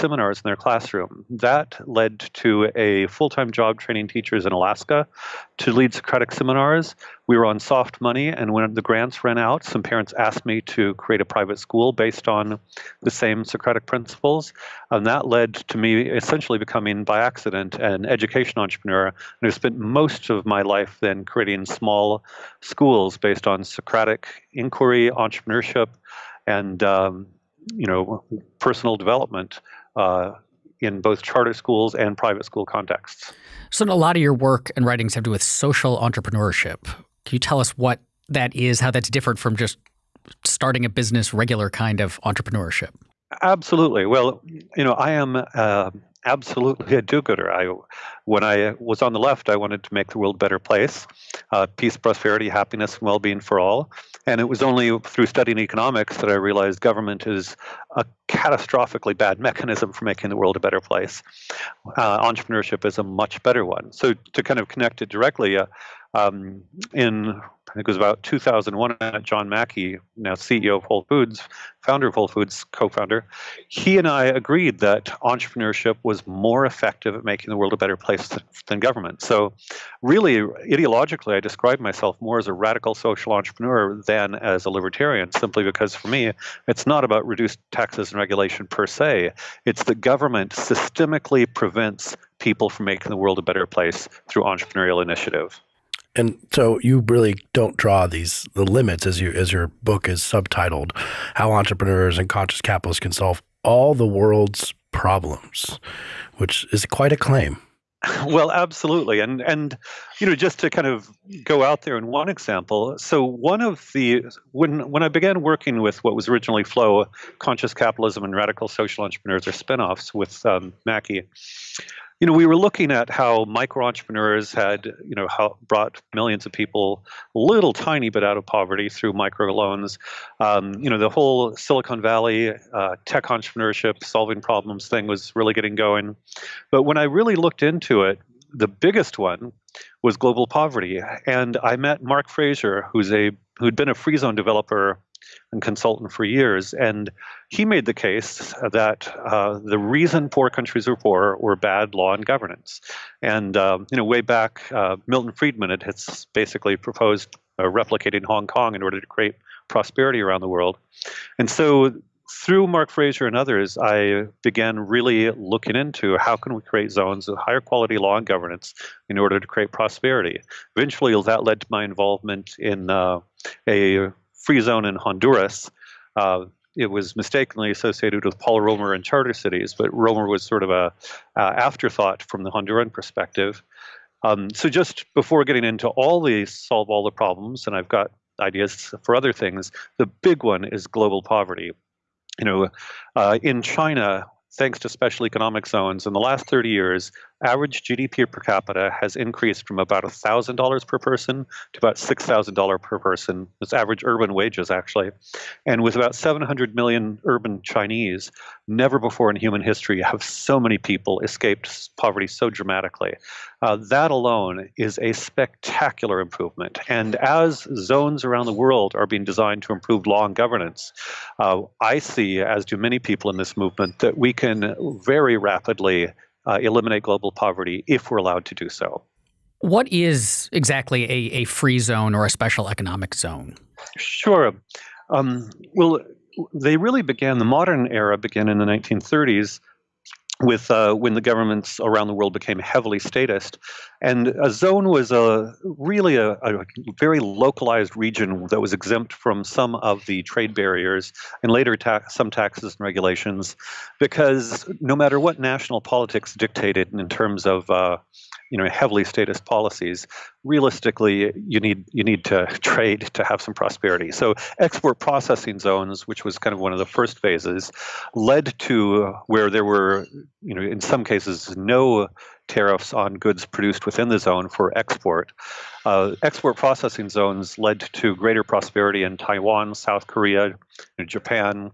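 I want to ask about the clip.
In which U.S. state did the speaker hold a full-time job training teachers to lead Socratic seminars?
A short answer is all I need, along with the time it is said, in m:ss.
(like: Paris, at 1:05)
Alaska, at 0:04.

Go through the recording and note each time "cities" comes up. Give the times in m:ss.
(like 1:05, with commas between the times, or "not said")
2:59.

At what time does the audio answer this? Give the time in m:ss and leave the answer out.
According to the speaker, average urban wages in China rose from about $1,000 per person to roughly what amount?
3:21.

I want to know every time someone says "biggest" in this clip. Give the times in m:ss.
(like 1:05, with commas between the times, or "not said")
2:18.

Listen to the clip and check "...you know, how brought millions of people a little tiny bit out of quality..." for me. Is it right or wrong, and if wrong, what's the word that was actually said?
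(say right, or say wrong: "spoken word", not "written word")
wrong: "poverty", not "quality".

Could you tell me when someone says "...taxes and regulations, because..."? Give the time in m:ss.
4:12.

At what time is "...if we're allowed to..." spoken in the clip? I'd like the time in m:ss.
3:47.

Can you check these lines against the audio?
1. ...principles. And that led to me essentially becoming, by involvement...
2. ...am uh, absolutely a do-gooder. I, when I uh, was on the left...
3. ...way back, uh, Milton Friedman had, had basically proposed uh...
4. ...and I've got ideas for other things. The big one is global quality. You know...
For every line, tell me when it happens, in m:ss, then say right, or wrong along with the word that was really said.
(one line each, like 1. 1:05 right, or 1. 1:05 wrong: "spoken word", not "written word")
1. 0:13 wrong: "accident", not "involvement"
2. 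0:45 right
3. 2:34 right
4. 3:07 wrong: "poverty", not "quality".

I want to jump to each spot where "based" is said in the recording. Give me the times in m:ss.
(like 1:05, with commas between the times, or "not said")
0:11, 0:23.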